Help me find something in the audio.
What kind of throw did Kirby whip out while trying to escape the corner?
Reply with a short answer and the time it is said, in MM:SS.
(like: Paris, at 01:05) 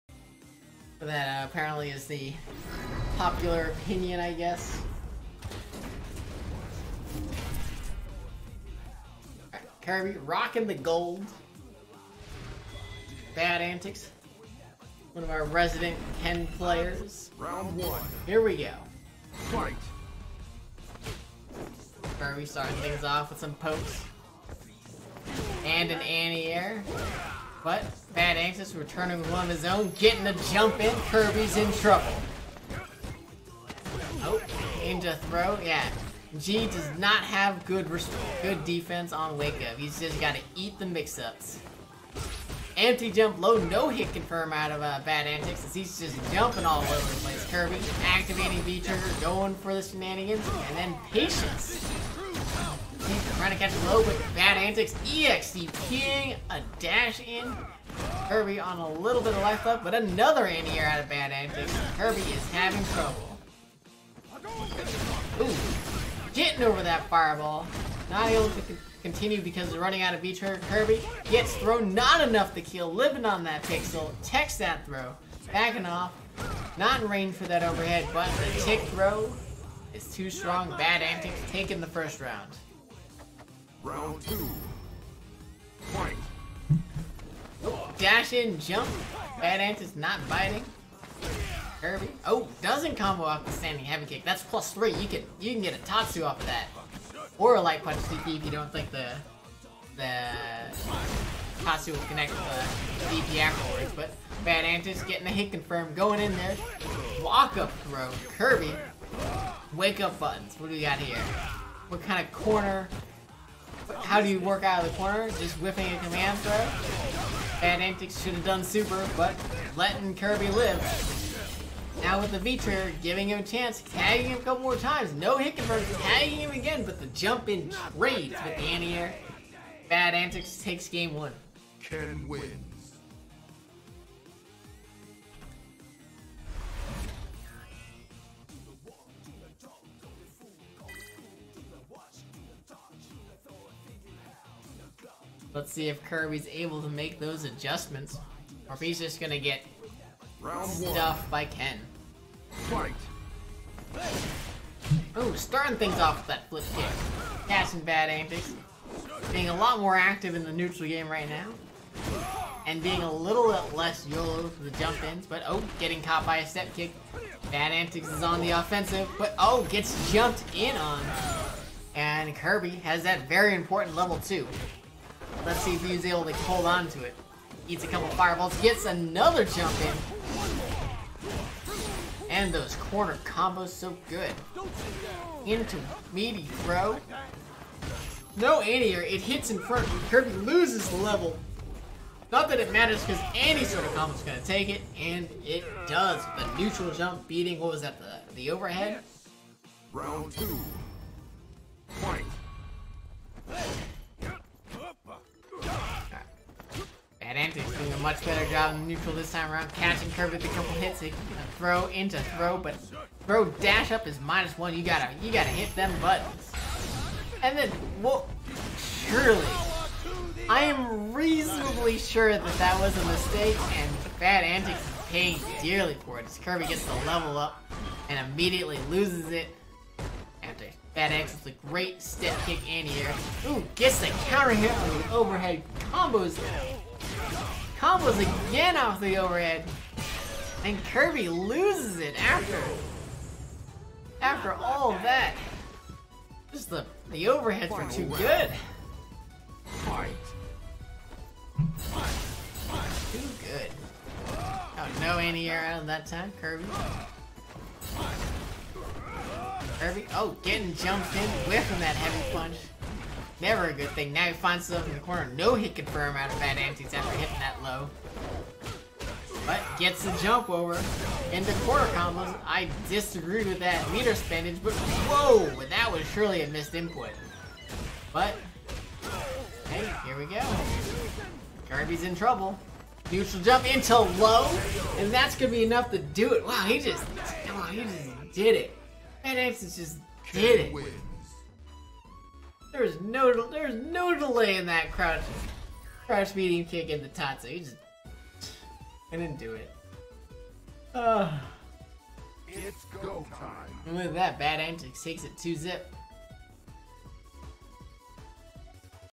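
command throw, at 01:55.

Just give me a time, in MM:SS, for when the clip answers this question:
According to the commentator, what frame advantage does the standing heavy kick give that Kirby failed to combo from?
01:34.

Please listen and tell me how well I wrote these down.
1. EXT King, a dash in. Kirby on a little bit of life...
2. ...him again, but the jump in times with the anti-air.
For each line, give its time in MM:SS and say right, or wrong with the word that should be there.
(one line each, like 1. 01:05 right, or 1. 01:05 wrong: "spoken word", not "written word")
1. 00:55 right
2. 02:06 wrong: "trades", not "times".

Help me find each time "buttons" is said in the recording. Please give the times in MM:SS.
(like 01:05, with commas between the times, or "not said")
01:50, 03:36.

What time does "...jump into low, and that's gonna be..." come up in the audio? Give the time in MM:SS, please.
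04:43.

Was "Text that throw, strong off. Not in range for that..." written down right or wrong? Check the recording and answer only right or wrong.
wrong.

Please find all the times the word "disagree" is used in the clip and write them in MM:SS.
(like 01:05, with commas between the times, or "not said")
04:32.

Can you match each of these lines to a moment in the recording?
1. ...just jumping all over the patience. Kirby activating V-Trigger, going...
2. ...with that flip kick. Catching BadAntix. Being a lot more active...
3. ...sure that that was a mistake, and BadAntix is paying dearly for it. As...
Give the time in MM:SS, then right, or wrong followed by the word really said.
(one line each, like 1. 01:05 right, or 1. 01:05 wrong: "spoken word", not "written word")
1. 00:45 wrong: "place", not "patience"
2. 02:36 right
3. 03:41 right.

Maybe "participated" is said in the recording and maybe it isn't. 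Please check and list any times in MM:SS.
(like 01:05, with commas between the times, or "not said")
not said.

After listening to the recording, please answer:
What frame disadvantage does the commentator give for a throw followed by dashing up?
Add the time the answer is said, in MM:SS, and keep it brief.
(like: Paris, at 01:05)
minus 1, at 03:34.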